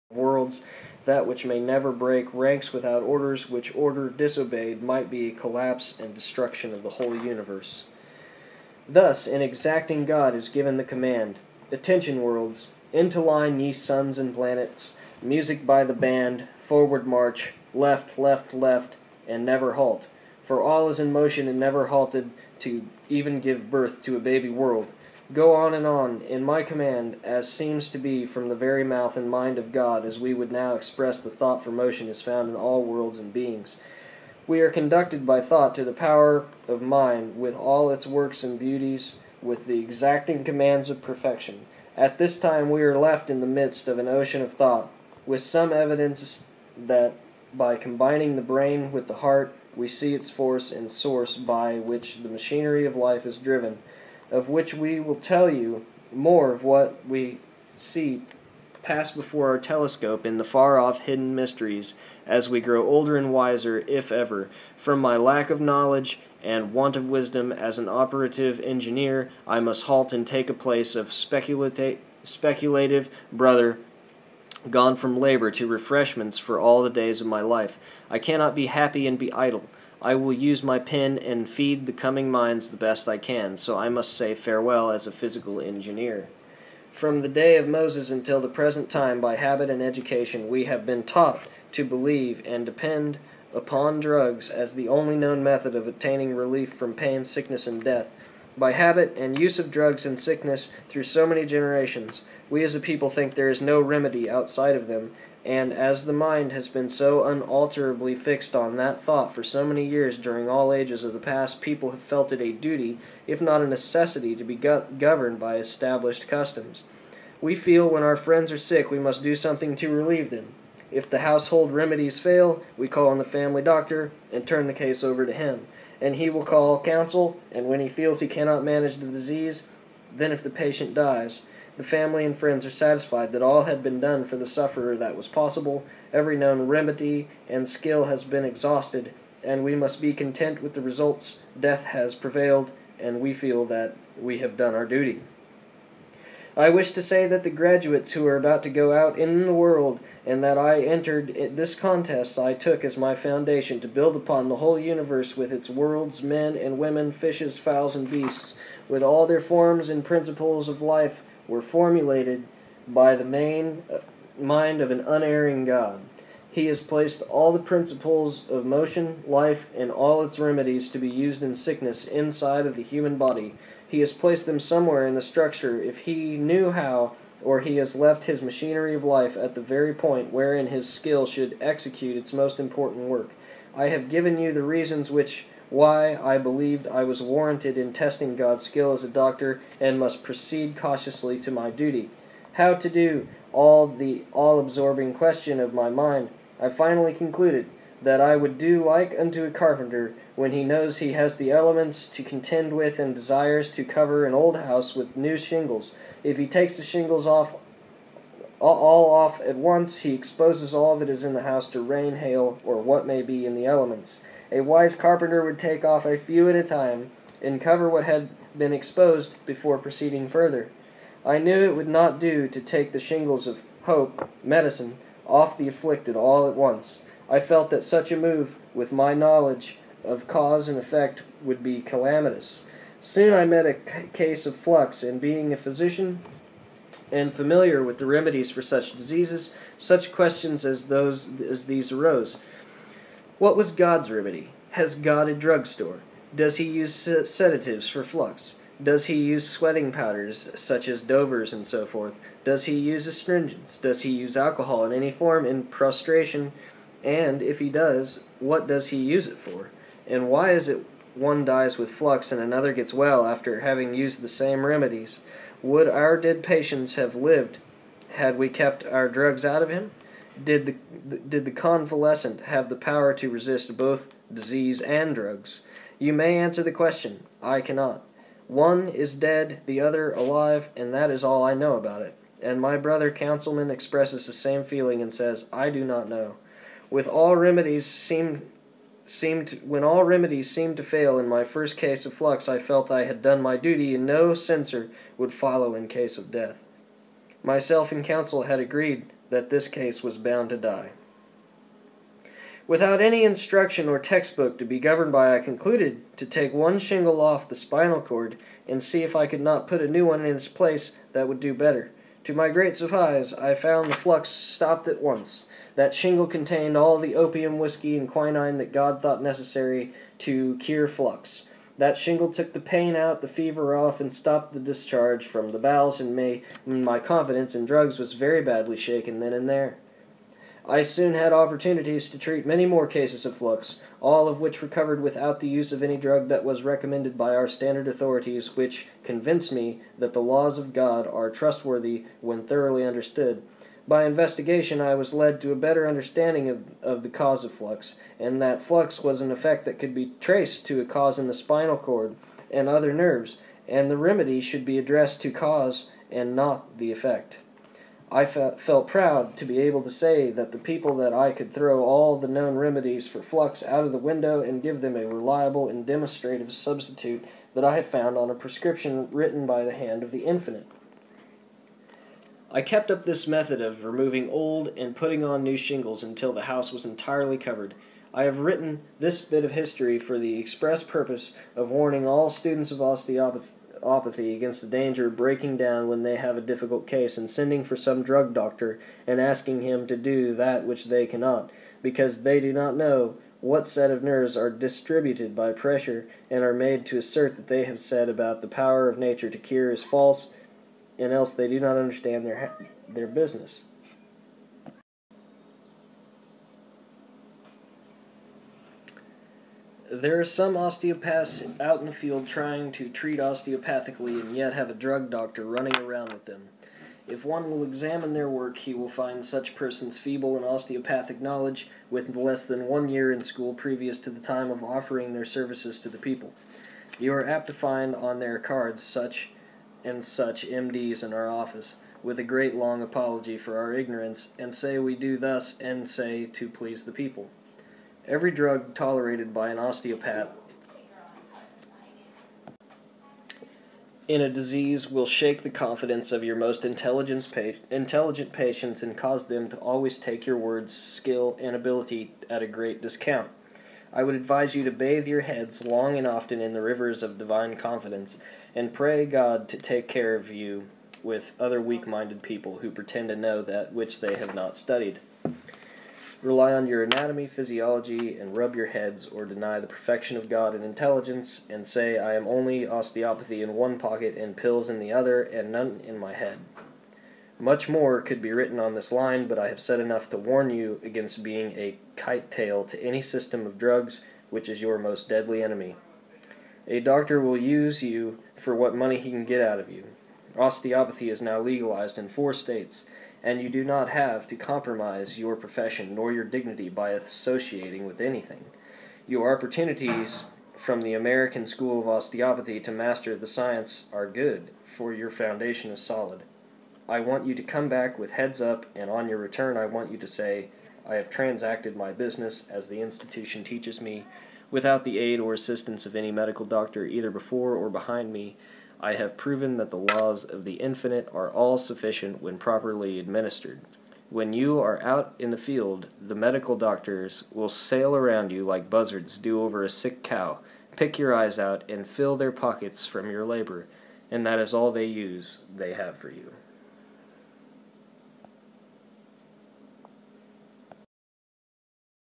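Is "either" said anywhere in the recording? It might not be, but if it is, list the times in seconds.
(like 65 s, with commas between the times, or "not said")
516 s.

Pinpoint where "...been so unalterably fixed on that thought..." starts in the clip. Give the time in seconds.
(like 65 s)
106 s.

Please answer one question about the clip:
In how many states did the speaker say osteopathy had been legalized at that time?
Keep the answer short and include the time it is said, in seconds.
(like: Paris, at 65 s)
4, at 492 s.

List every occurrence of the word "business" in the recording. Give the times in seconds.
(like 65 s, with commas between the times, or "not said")
403 s, 511 s.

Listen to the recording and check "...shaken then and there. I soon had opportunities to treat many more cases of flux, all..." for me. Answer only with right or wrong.
right.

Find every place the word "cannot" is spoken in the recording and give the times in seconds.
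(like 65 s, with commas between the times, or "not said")
78 s, 128 s, 277 s, 391 s.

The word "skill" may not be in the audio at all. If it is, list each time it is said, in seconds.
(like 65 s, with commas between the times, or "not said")
137 s, 180 s, 188 s, 450 s.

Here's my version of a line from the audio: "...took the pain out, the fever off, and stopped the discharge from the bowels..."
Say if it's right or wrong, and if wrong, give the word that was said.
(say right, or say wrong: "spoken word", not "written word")
right.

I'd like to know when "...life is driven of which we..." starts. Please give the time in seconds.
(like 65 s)
52 s.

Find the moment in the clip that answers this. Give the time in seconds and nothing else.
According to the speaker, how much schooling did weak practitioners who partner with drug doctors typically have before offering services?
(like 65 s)
422 s.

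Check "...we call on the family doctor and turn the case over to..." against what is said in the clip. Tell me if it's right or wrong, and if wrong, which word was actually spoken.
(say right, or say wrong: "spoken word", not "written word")
right.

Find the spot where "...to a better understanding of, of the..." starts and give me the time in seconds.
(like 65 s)
345 s.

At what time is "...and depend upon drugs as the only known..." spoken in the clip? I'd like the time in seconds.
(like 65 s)
92 s.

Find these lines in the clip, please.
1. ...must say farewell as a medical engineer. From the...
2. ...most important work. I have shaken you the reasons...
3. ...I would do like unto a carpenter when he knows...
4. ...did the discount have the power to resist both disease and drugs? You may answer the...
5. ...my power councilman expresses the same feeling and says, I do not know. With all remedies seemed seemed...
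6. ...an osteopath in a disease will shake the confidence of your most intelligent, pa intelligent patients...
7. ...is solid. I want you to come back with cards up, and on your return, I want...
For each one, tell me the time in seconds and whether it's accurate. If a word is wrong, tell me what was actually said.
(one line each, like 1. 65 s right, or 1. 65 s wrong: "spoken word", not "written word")
1. 83 s wrong: "physical", not "medical"
2. 182 s wrong: "given", not "shaken"
3. 198 s right
4. 271 s wrong: "convalescent", not "discount"
5. 282 s wrong: "brother", not "power"
6. 439 s right
7. 505 s wrong: "heads", not "cards".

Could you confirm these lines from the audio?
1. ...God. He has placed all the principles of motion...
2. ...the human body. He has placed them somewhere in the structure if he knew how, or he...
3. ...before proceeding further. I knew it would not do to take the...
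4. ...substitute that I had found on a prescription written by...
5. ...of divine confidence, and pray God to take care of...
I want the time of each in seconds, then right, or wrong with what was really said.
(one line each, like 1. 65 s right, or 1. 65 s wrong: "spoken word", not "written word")
1. 165 s right
2. 172 s right
3. 219 s right
4. 366 s right
5. 457 s right.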